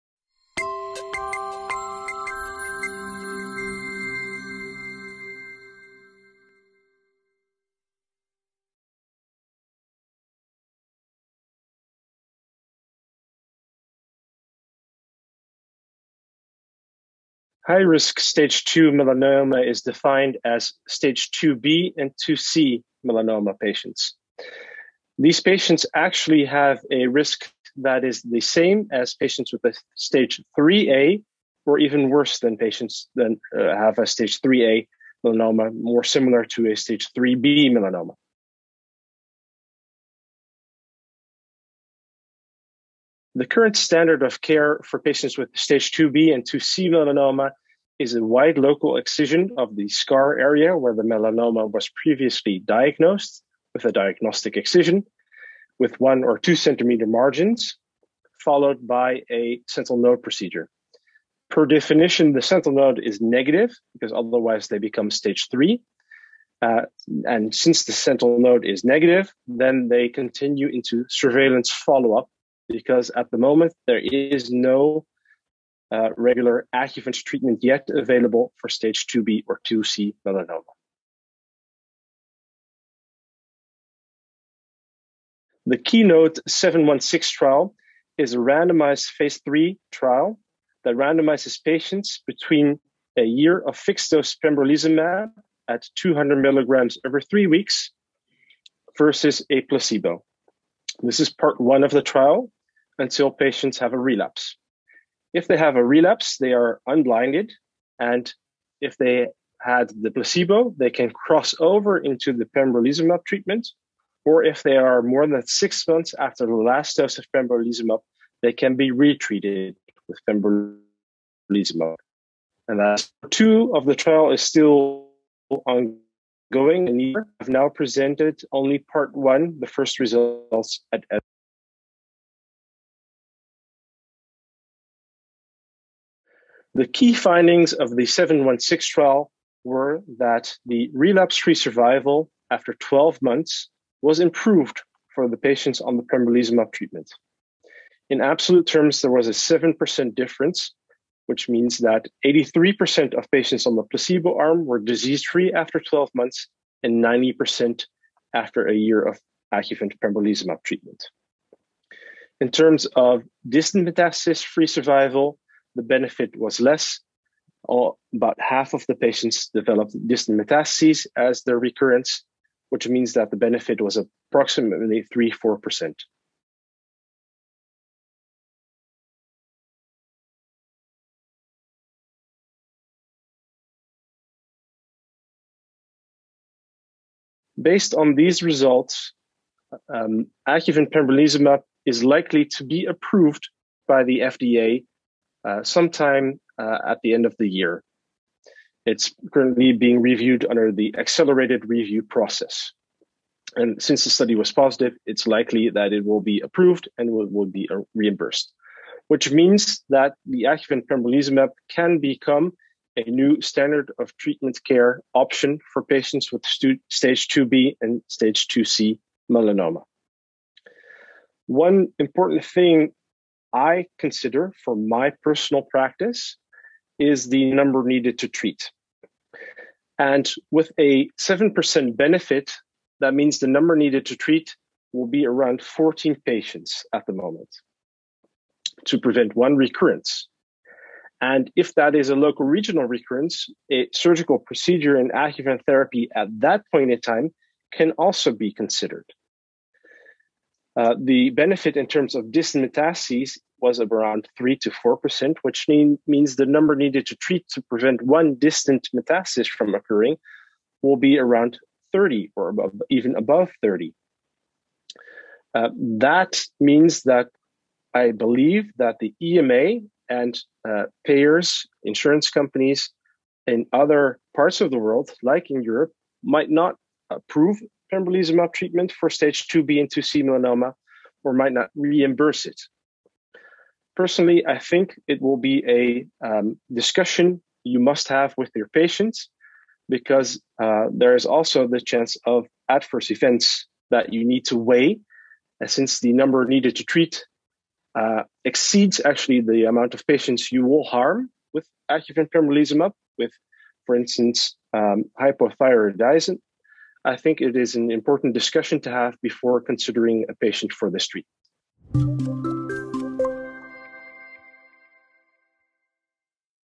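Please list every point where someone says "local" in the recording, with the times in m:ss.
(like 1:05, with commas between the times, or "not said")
0:48, 4:02.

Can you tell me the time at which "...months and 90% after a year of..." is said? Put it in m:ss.
2:36.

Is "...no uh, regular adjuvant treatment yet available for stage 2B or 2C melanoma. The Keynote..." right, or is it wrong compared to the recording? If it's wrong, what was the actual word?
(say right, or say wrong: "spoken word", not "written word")
right.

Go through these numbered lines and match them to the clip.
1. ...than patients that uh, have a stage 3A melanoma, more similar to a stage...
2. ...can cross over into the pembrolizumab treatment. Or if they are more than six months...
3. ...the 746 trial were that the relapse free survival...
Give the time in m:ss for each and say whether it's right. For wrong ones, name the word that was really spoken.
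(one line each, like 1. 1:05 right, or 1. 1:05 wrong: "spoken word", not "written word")
1. 0:32 right
2. 1:50 right
3. 2:17 wrong: "716", not "746".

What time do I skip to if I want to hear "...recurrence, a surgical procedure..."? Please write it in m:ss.
4:02.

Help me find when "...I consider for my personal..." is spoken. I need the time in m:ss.
3:43.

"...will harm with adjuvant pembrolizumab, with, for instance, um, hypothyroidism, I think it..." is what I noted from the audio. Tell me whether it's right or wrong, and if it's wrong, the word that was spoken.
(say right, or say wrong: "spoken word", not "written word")
right.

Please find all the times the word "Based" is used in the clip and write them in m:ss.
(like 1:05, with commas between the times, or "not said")
3:07.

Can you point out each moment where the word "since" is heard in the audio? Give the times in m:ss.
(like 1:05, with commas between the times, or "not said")
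1:07, 3:23, 4:55.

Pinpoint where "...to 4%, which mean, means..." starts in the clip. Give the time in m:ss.
4:14.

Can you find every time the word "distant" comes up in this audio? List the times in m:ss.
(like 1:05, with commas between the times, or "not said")
2:43, 2:50, 4:12, 4:18.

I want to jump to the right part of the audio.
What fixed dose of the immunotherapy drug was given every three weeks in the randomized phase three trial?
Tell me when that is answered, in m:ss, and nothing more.
1:35.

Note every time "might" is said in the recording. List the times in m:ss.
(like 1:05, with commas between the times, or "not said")
4:36, 4:41.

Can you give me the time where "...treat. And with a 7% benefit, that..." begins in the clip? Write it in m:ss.
3:48.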